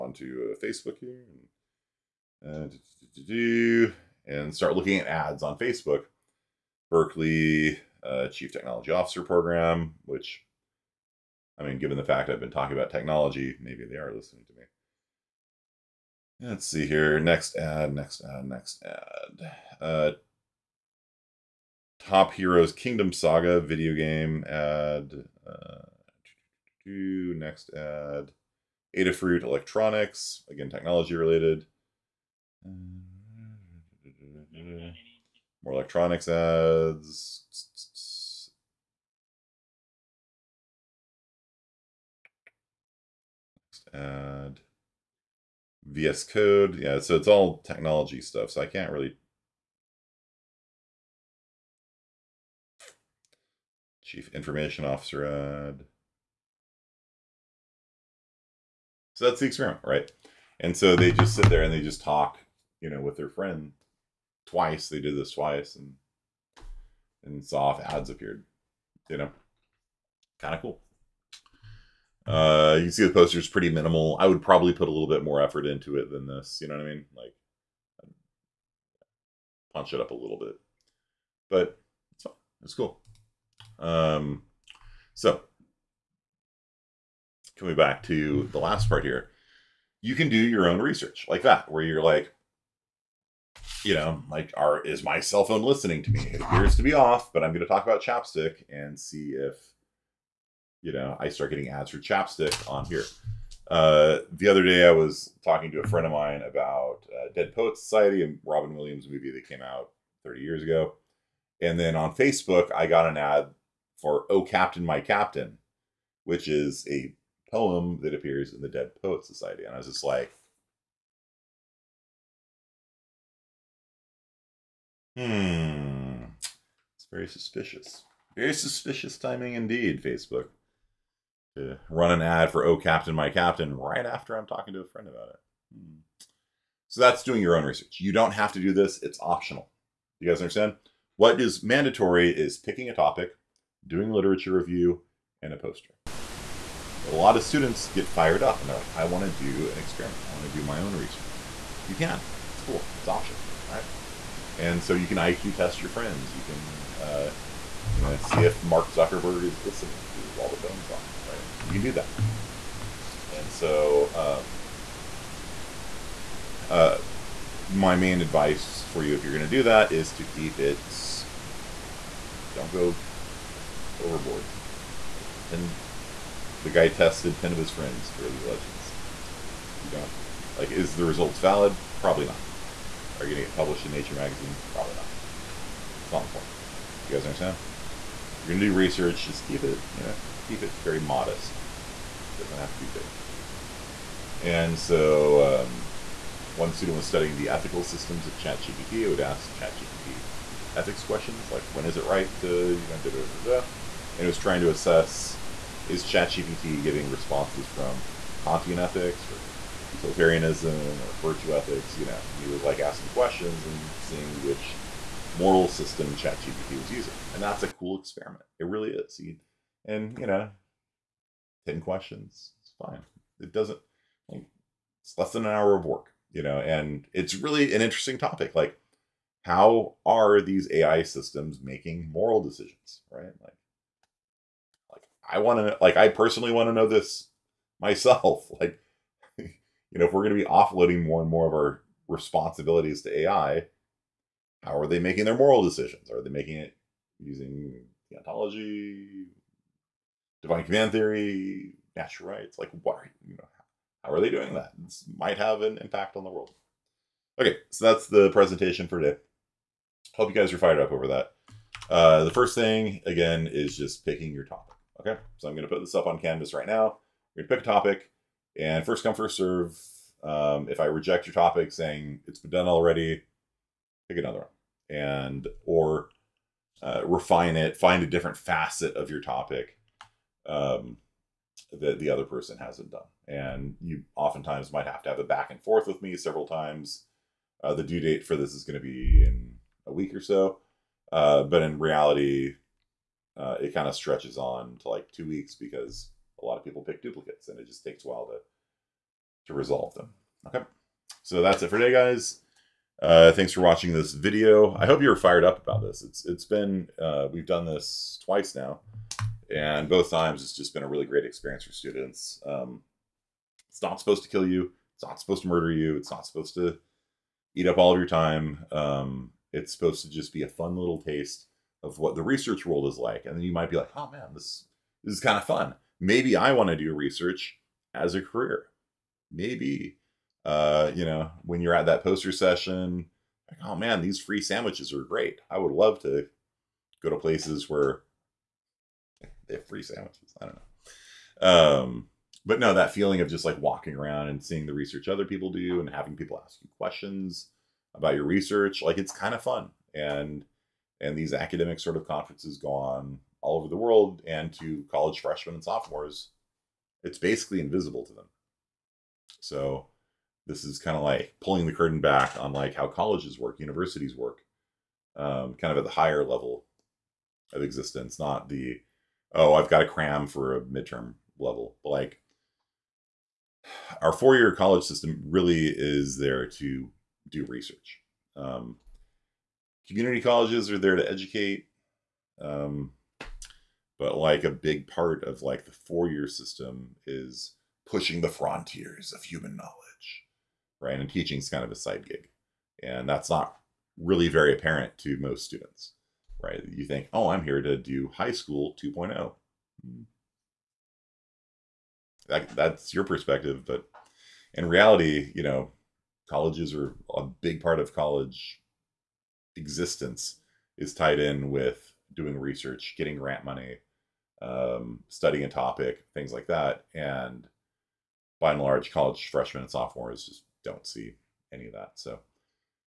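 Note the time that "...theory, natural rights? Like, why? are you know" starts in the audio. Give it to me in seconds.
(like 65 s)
250 s.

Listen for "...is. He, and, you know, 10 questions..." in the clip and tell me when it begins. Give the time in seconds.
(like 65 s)
218 s.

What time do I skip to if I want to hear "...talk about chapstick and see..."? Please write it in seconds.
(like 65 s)
97 s.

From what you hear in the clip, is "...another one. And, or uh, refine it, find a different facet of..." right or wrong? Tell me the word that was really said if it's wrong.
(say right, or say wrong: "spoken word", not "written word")
right.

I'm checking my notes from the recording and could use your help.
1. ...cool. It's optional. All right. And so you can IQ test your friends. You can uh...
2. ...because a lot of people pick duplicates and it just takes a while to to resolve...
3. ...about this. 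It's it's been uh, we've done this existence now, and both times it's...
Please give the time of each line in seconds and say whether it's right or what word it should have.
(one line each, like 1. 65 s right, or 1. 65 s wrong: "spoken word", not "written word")
1. 152 s right
2. 295 s right
3. 305 s wrong: "twice", not "existence".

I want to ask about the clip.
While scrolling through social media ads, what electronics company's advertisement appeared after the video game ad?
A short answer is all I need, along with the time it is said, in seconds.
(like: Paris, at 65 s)
Adafruit, at 28 s.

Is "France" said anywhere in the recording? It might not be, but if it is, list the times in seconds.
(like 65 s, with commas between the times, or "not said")
not said.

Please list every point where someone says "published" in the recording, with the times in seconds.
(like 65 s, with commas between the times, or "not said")
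183 s.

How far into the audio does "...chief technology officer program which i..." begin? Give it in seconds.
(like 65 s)
8 s.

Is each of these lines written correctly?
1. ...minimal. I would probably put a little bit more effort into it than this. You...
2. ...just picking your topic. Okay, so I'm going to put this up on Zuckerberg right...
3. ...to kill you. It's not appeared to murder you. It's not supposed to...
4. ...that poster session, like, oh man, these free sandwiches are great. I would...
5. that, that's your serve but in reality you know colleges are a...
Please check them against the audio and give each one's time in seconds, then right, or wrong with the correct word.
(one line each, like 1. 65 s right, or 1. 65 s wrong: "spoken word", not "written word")
1. 73 s right
2. 263 s wrong: "Canvas", not "Zuckerberg"
3. 314 s wrong: "supposed", not "appeared"
4. 331 s right
5. 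402 s wrong: "perspective", not "serve".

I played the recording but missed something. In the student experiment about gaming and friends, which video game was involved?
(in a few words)
League of Legends.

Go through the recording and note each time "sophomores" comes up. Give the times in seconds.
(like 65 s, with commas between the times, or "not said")
355 s, 419 s.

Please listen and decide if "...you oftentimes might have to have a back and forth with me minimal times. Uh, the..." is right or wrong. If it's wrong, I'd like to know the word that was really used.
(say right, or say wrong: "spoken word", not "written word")
wrong: "several", not "minimal".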